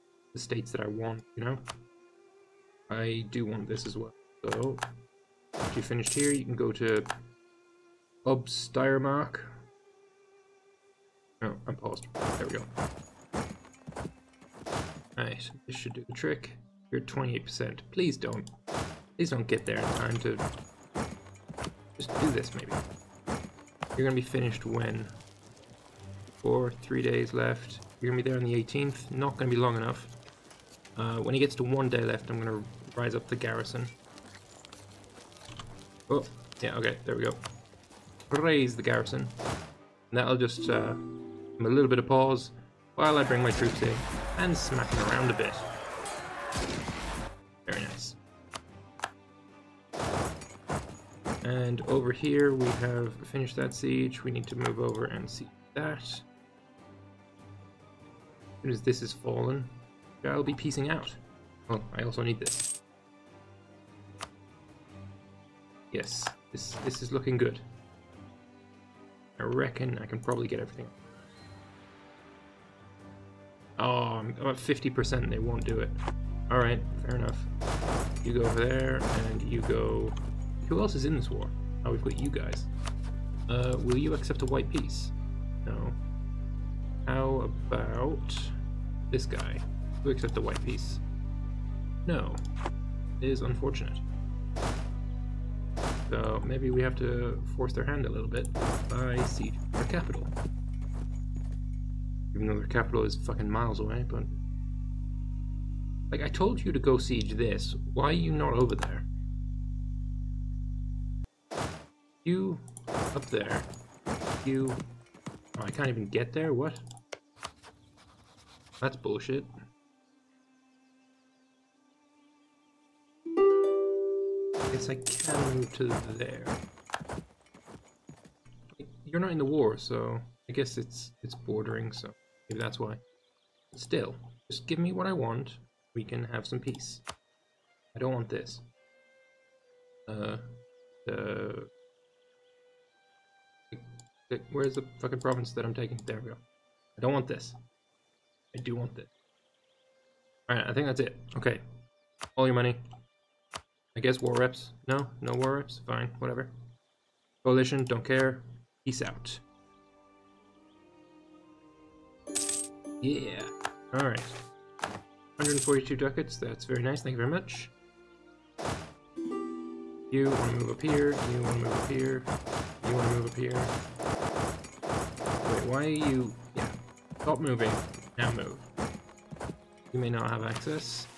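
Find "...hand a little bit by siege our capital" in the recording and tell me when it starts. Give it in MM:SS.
01:37.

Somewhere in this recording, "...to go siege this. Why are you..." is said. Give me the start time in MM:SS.
01:46.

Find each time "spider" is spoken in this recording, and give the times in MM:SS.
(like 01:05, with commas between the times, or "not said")
not said.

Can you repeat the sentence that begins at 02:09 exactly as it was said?
You're not in the war, so I guess it's it's bordering, so...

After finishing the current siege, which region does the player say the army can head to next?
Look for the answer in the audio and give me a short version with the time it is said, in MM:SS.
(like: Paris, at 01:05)
Obsteirmark, at 00:08.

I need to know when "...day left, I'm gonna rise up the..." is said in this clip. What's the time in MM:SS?
00:31.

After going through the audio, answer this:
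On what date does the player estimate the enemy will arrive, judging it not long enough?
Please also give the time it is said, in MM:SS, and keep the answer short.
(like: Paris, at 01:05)
the 18th, at 00:28.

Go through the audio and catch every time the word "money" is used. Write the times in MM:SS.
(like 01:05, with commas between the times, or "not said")
02:32.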